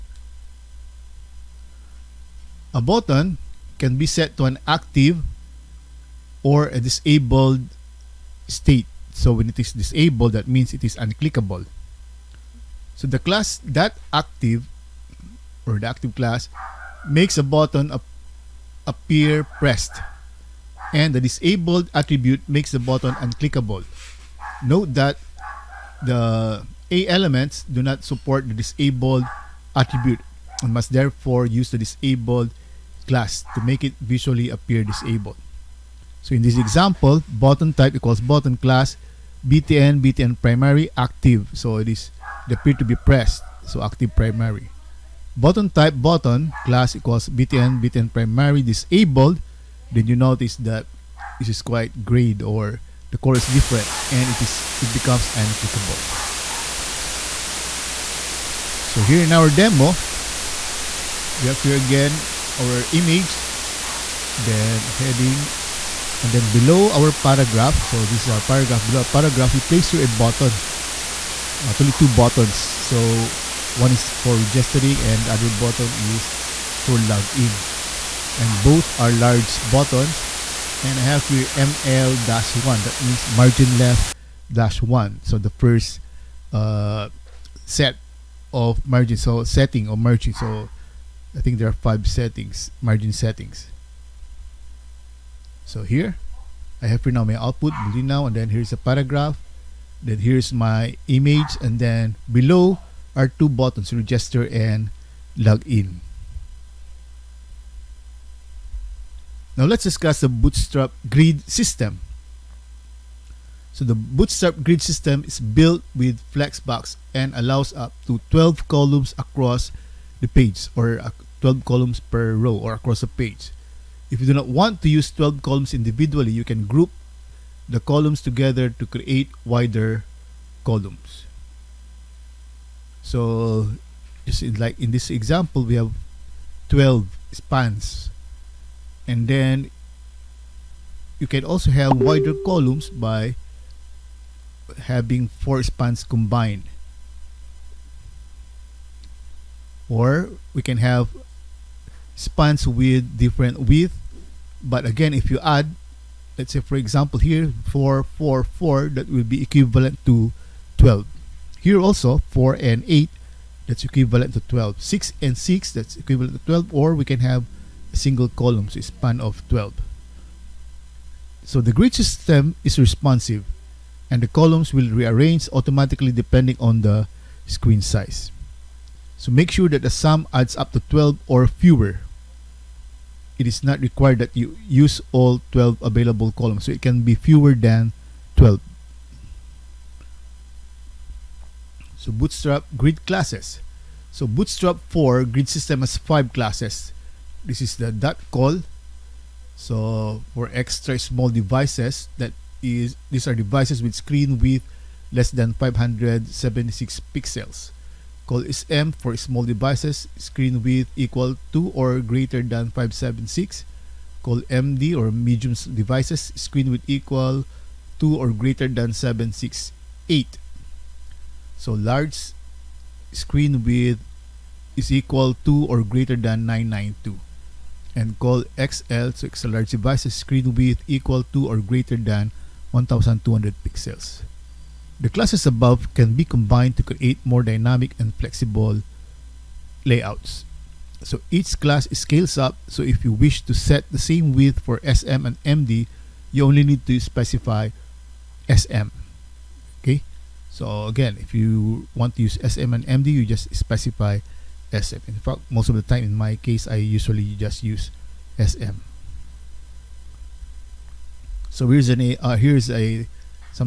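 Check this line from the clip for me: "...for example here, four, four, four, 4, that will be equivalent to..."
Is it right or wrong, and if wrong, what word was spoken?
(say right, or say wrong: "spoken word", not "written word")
right.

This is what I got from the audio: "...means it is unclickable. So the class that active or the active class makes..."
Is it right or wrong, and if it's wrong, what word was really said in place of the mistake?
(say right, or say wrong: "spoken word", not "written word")
right.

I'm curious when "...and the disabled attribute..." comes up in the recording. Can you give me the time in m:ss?
0:20.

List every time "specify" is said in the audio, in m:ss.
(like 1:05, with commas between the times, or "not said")
4:07, 4:13.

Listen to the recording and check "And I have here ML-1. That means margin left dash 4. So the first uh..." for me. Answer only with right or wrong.
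wrong.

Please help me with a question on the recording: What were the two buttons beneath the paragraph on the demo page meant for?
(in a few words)
Register and login.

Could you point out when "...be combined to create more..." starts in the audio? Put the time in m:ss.
3:56.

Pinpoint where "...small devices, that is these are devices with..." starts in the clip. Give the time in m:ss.
3:20.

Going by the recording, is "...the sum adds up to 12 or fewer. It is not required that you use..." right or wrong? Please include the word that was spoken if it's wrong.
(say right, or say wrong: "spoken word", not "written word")
right.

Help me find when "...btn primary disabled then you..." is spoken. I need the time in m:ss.
0:47.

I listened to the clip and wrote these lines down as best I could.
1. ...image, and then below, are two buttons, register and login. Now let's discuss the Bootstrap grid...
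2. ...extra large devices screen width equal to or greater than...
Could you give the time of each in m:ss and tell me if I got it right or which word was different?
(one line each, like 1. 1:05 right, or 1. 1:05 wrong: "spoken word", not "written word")
1. 1:41 right
2. 3:49 right.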